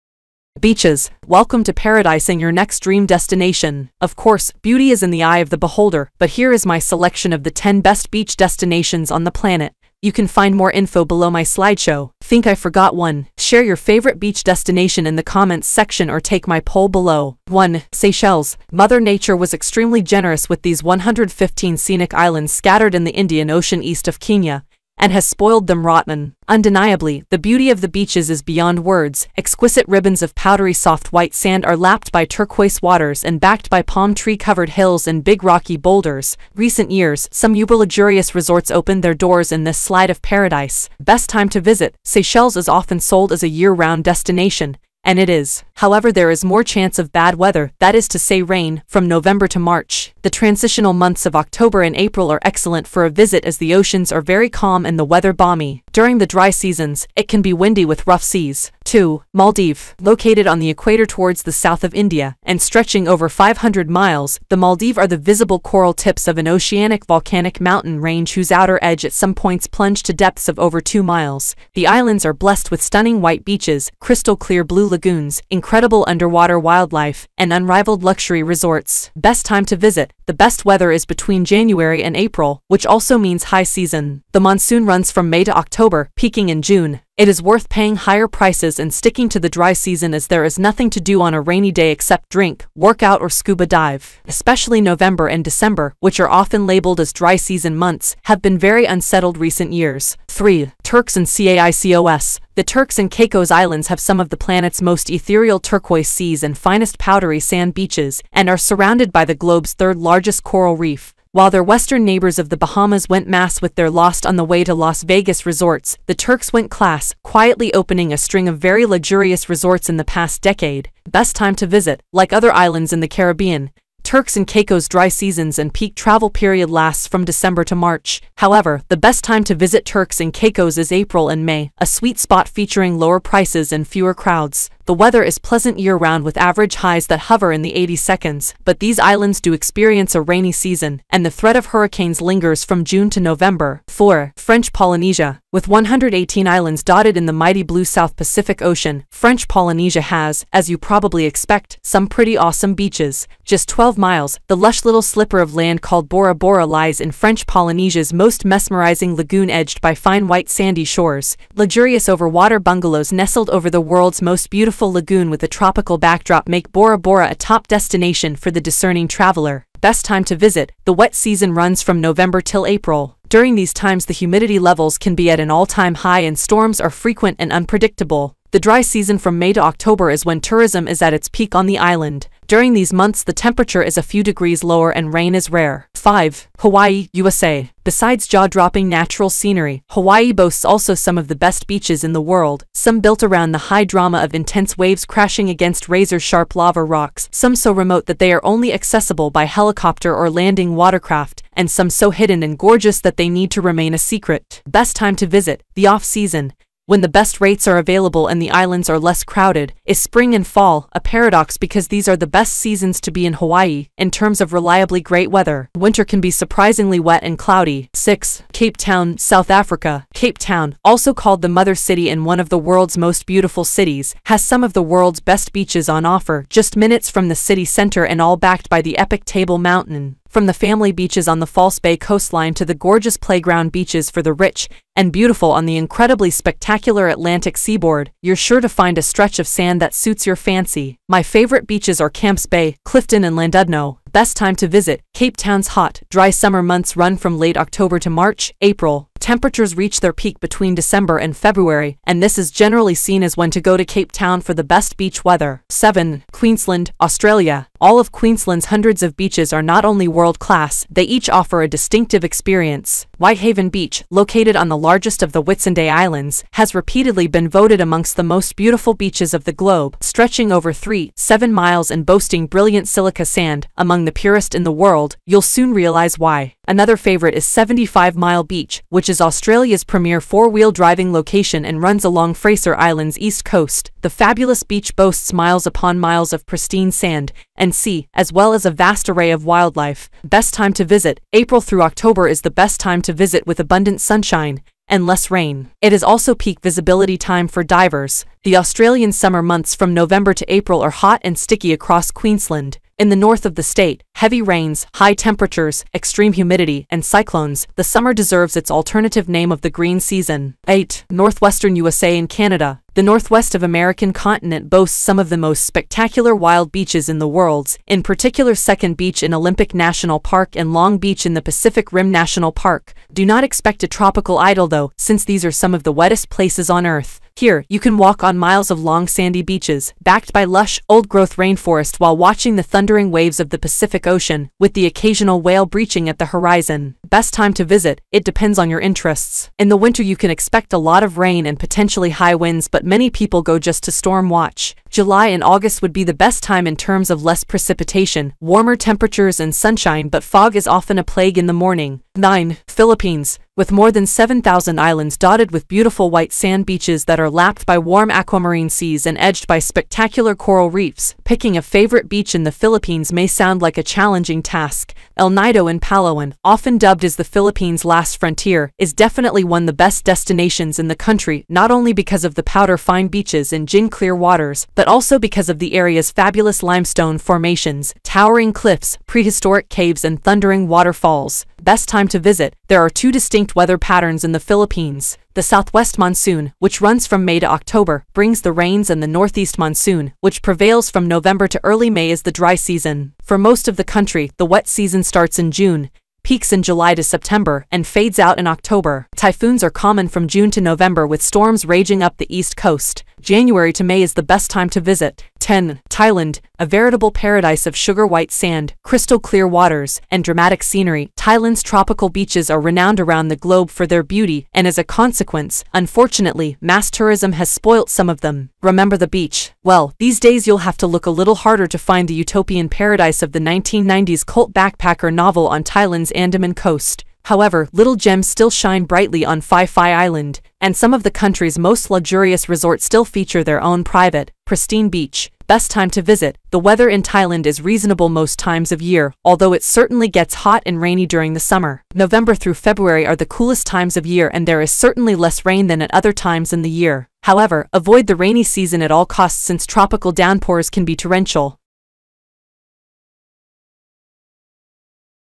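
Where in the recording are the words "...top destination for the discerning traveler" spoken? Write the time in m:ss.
2:47.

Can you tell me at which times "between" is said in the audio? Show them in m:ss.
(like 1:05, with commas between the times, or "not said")
1:21, 4:10.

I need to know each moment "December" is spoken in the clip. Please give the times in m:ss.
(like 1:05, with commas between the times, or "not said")
1:35, 2:07, 4:10.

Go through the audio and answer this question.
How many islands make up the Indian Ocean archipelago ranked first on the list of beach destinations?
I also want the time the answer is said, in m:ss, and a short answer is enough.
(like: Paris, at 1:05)
115, at 0:20.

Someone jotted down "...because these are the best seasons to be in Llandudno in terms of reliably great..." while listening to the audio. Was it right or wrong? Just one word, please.
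wrong.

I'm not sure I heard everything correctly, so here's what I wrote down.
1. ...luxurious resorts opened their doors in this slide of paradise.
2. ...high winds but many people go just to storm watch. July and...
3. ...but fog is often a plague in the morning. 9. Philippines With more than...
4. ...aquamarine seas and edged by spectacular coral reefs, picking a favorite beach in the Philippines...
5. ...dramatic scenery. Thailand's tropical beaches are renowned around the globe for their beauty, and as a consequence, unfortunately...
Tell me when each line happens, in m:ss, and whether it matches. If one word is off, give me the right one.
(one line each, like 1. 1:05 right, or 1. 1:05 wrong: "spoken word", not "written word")
1. 0:37 right
2. 5:42 right
3. 5:50 right
4. 5:58 right
5. 6:50 right.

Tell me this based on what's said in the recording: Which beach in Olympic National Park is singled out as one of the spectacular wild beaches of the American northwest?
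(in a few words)
Second Beach.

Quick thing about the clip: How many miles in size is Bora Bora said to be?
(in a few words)
12 miles.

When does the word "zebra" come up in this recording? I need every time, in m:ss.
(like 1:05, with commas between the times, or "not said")
not said.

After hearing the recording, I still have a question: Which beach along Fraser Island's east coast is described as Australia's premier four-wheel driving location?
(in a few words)
75 Mile Beach.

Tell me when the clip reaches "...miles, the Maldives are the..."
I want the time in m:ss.
1:03.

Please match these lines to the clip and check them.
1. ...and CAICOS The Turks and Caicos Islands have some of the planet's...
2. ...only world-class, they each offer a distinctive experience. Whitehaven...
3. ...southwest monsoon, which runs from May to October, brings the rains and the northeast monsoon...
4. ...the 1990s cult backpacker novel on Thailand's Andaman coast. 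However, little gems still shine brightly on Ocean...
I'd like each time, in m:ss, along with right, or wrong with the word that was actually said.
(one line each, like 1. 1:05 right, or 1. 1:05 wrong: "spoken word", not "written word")
1. 1:41 right
2. 4:19 right
3. 6:25 right
4. 7:03 wrong: "Phi", not "Ocean".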